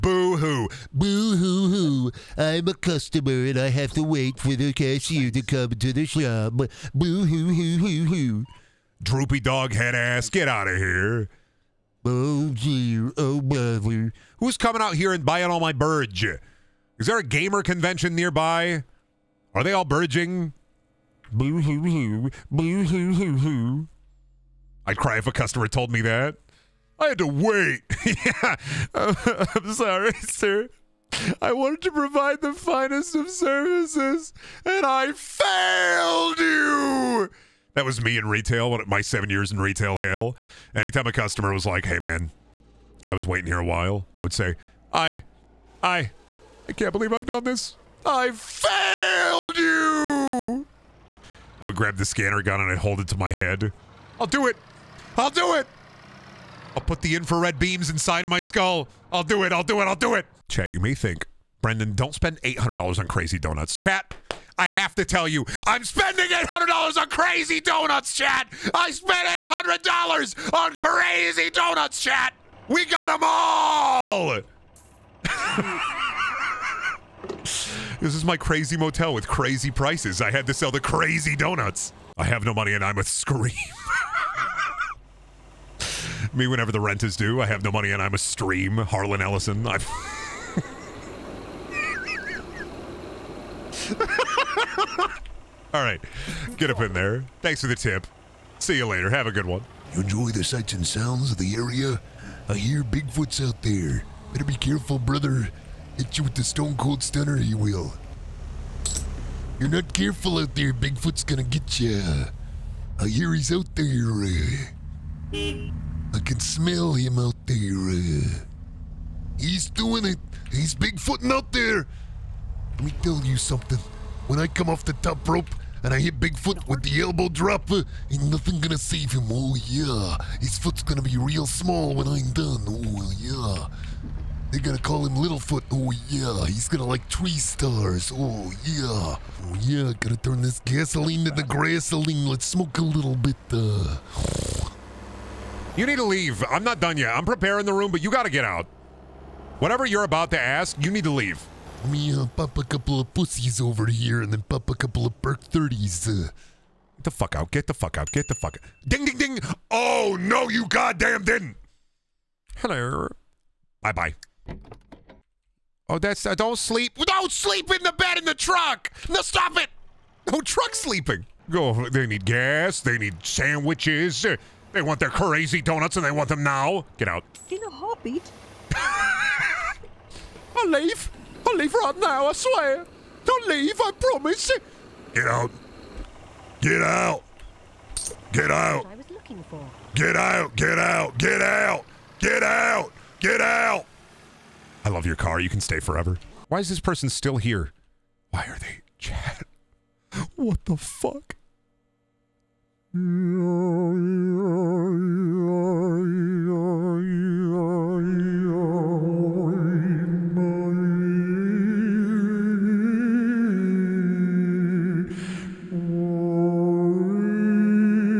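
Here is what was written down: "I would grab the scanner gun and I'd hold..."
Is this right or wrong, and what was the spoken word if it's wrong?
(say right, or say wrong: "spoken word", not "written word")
right.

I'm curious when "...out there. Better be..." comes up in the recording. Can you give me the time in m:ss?
1:43.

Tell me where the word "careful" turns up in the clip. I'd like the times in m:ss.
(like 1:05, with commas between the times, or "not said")
1:44, 1:49.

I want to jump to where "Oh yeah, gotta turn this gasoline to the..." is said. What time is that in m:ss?
2:19.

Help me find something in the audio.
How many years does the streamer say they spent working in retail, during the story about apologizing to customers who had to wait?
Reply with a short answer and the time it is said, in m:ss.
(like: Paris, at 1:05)
7, at 0:39.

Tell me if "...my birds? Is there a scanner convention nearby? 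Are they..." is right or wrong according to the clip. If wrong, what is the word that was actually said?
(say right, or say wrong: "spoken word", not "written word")
wrong: "gamer", not "scanner".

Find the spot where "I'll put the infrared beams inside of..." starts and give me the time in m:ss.
0:56.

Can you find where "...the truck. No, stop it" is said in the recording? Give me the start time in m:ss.
2:48.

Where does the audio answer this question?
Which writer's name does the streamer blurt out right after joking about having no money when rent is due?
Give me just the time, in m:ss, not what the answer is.
1:28.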